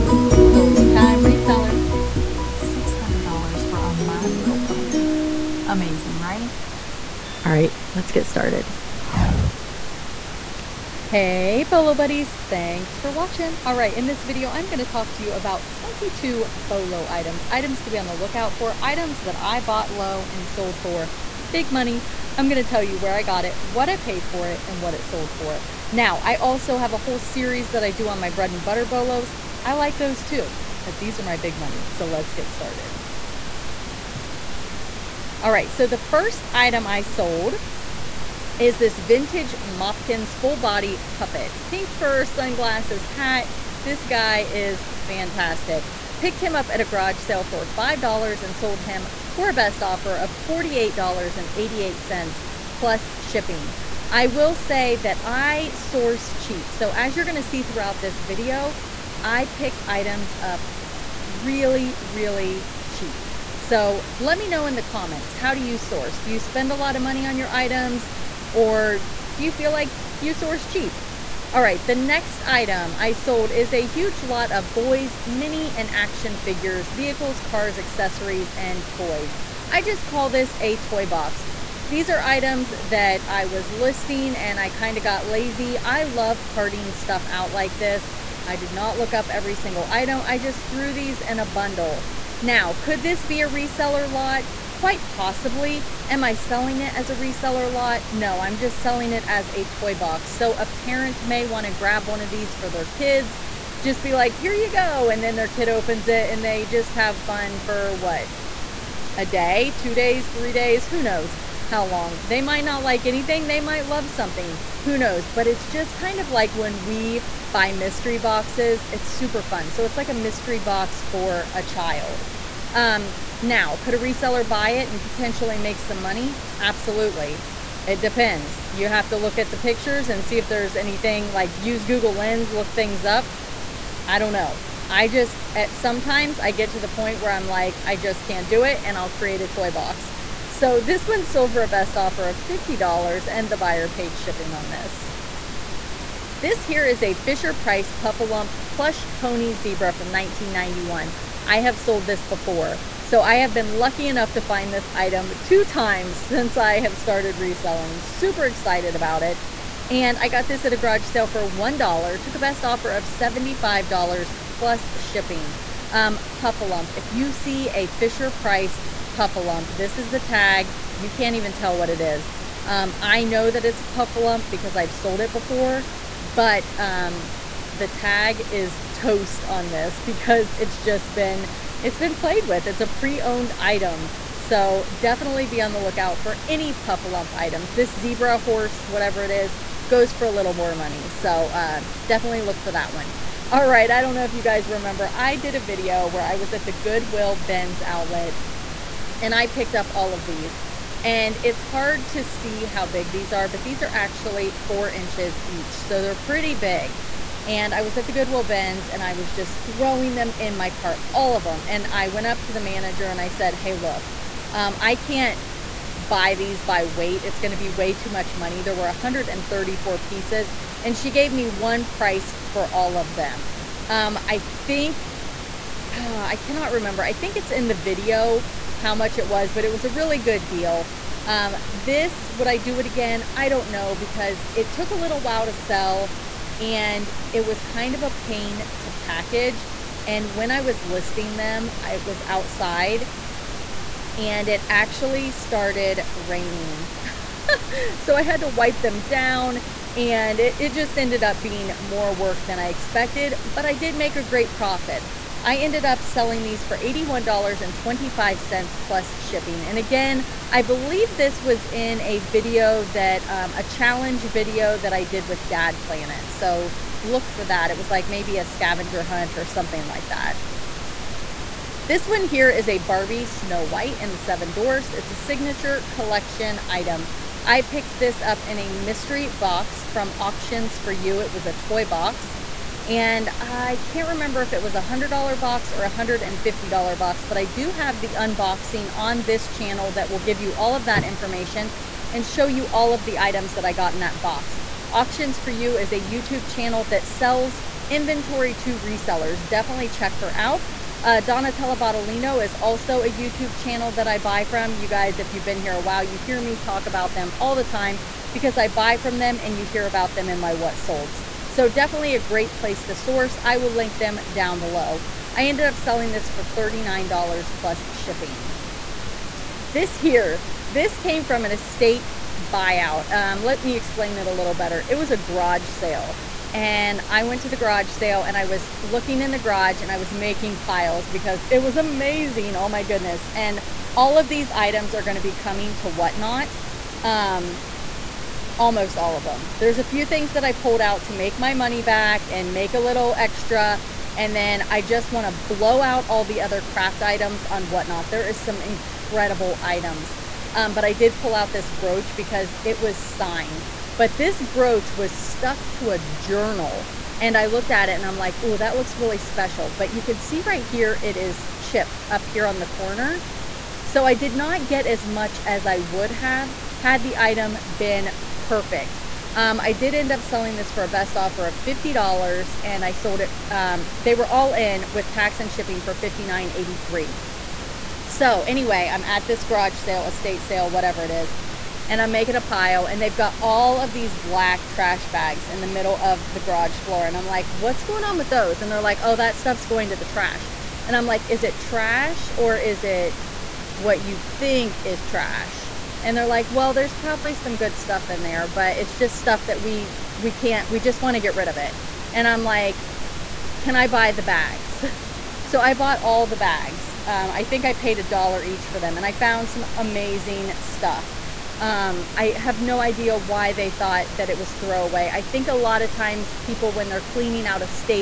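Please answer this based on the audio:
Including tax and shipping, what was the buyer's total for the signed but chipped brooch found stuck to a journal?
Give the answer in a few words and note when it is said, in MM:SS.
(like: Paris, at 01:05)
$59.83, at 06:15.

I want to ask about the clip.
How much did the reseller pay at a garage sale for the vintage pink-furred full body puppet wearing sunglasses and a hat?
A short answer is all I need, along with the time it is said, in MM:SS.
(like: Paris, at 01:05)
$5, at 00:47.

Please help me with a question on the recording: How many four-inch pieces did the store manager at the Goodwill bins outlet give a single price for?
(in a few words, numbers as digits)
134.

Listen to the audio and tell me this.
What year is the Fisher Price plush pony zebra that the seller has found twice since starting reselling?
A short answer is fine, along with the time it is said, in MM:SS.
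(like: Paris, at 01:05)
1991, at 02:30.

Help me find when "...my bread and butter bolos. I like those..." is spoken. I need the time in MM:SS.
00:28.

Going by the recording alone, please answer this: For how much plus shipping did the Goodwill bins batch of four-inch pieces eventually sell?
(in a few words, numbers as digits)
$81.25.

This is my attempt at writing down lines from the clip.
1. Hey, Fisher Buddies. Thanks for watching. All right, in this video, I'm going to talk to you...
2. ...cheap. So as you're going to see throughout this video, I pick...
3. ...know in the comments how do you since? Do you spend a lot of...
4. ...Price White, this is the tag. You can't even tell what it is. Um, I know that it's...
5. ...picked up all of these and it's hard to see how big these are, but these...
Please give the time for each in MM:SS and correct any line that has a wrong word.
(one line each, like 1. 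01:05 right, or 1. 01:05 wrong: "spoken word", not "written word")
1. 00:11 wrong: "Bolo", not "Fisher"
2. 00:56 right
3. 01:04 wrong: "source", not "since"
4. 02:48 wrong: "Puffalump", not "White"
5. 03:19 right.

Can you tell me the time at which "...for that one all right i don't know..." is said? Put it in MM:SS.
03:12.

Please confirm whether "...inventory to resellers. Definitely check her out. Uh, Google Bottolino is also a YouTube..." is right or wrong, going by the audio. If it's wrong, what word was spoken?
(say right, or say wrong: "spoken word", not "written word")
wrong: "Donatella", not "Google".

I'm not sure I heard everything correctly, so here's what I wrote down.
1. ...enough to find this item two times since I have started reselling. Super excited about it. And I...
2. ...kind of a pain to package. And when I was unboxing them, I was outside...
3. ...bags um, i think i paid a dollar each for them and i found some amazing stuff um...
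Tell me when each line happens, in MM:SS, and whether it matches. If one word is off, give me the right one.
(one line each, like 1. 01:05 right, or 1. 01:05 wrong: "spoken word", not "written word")
1. 02:34 right
2. 03:57 wrong: "listing", not "unboxing"
3. 06:46 right.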